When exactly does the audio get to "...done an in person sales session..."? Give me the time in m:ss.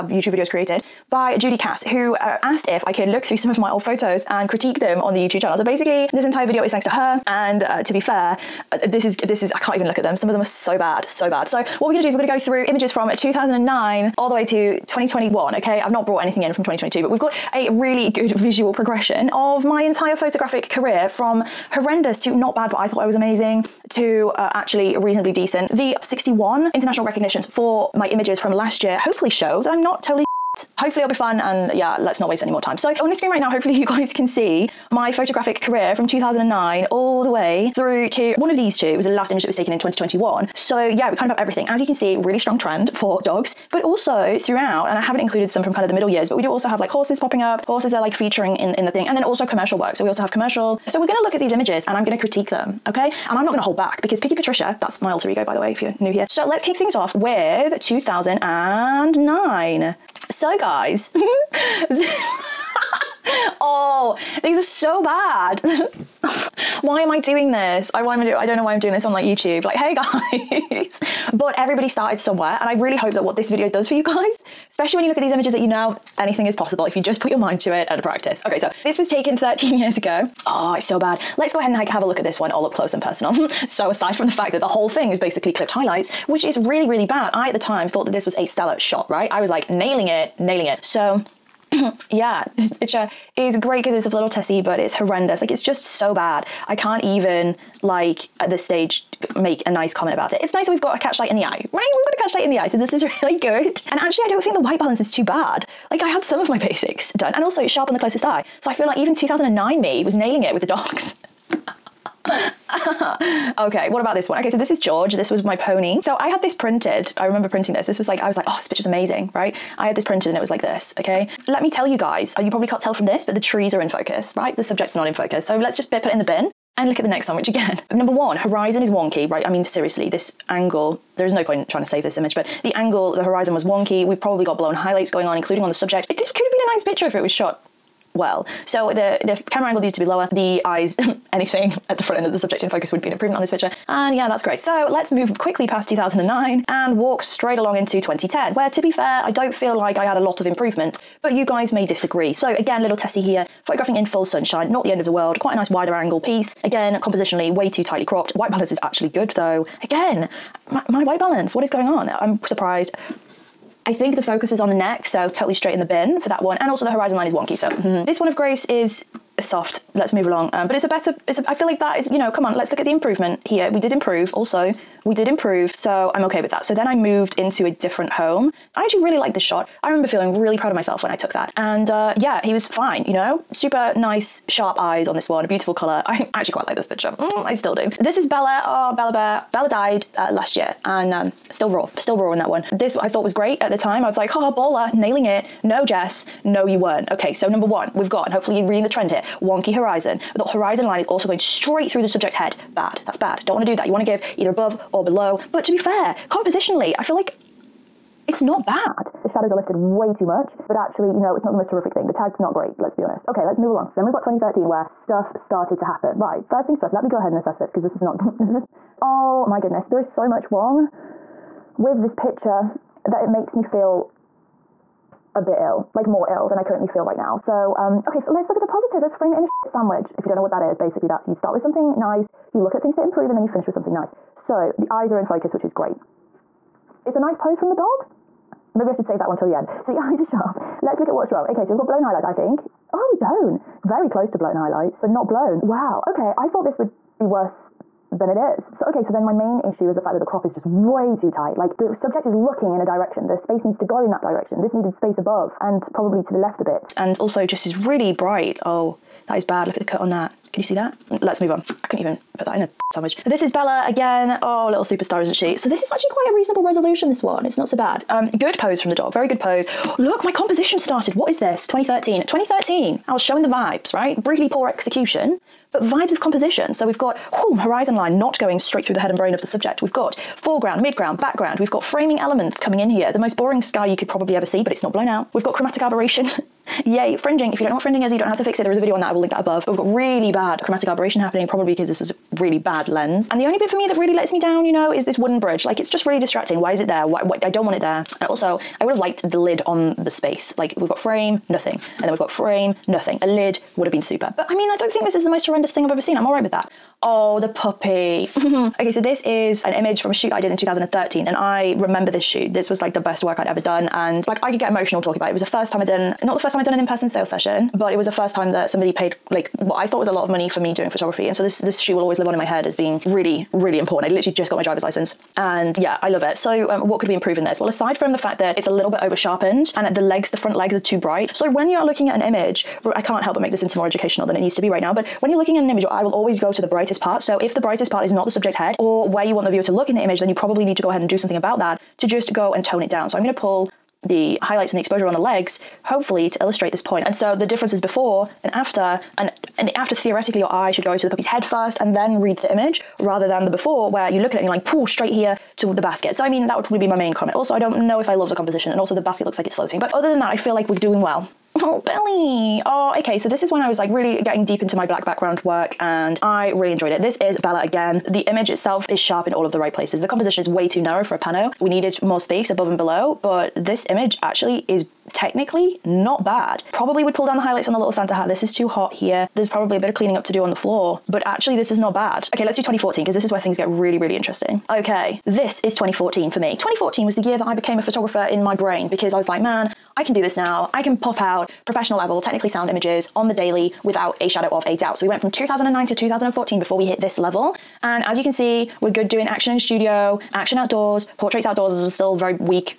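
5:16.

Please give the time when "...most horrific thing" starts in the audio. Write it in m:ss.
3:31.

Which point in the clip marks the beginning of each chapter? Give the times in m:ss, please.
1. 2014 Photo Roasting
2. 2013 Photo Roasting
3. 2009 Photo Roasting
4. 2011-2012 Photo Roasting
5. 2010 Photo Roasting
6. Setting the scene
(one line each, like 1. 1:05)
1. 6:21
2. 3:33
3. 0:57
4. 2:56
5. 2:25
6. 0:33.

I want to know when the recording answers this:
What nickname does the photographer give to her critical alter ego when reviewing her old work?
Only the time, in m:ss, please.
0:54.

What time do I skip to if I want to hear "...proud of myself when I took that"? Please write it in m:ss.
3:00.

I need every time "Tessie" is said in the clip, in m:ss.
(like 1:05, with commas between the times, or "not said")
1:34, 2:32.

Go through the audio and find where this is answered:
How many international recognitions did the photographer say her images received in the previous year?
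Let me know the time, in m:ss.
0:26.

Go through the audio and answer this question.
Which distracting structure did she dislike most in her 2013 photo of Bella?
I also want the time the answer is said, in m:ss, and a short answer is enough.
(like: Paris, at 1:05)
wooden bridge, at 4:55.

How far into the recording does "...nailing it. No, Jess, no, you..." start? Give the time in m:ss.
3:14.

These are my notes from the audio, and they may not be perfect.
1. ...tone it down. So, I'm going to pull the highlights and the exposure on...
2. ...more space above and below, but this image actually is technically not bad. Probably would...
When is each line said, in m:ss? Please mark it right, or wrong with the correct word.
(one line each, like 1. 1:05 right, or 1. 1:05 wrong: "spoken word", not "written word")
1. 5:42 right
2. 6:12 right.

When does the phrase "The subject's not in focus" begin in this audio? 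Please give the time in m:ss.
2:04.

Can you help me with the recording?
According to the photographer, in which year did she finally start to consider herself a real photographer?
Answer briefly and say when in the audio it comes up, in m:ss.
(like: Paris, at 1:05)
2014, at 6:26.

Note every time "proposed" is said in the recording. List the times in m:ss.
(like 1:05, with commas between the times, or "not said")
not said.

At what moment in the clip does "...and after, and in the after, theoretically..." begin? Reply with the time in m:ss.
5:48.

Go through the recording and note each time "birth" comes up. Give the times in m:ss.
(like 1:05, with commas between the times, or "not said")
not said.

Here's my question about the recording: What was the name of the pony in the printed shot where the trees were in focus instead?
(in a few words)
George.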